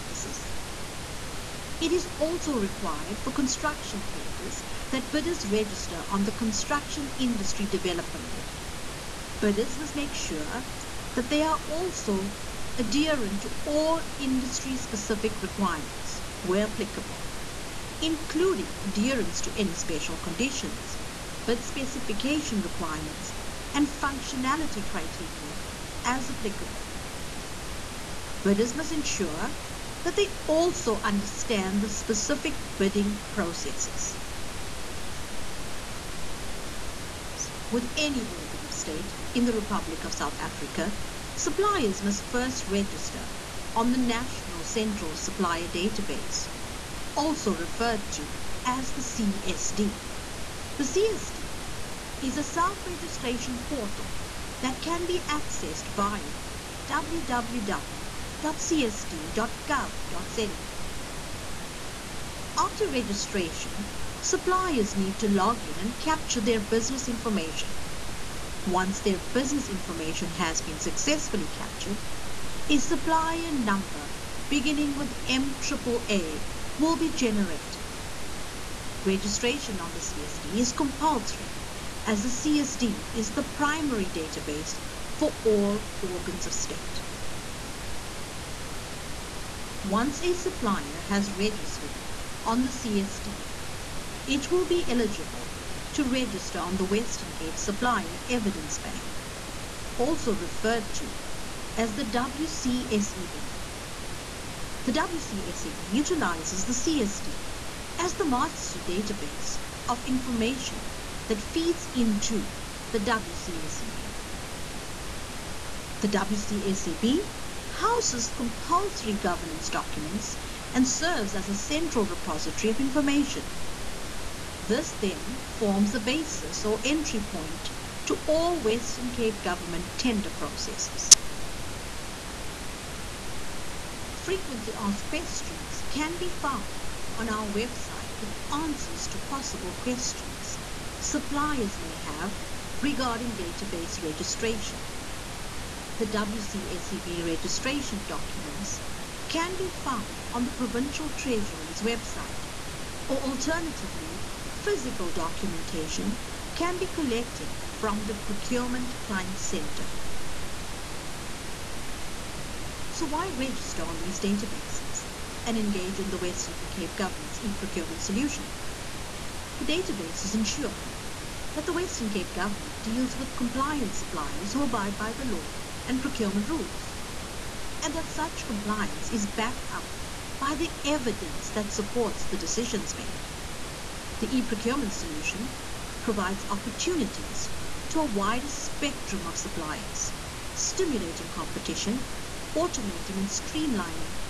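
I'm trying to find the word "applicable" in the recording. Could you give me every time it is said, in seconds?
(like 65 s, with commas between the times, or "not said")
16 s, 26 s.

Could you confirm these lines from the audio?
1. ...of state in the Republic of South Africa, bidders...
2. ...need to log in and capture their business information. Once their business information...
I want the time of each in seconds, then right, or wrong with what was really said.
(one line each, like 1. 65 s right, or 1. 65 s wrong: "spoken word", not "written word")
1. 38 s wrong: "suppliers", not "bidders"
2. 64 s right.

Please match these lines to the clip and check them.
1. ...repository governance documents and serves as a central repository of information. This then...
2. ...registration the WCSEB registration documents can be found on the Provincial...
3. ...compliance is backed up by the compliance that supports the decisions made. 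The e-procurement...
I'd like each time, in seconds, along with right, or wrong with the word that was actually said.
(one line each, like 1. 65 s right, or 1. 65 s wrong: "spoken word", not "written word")
1. 118 s wrong: "compulsory", not "repository"
2. 144 s right
3. 178 s wrong: "evidence", not "compliance".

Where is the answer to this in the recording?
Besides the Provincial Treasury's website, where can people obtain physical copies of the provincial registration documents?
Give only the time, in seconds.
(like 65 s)
158 s.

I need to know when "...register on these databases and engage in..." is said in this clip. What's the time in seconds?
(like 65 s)
163 s.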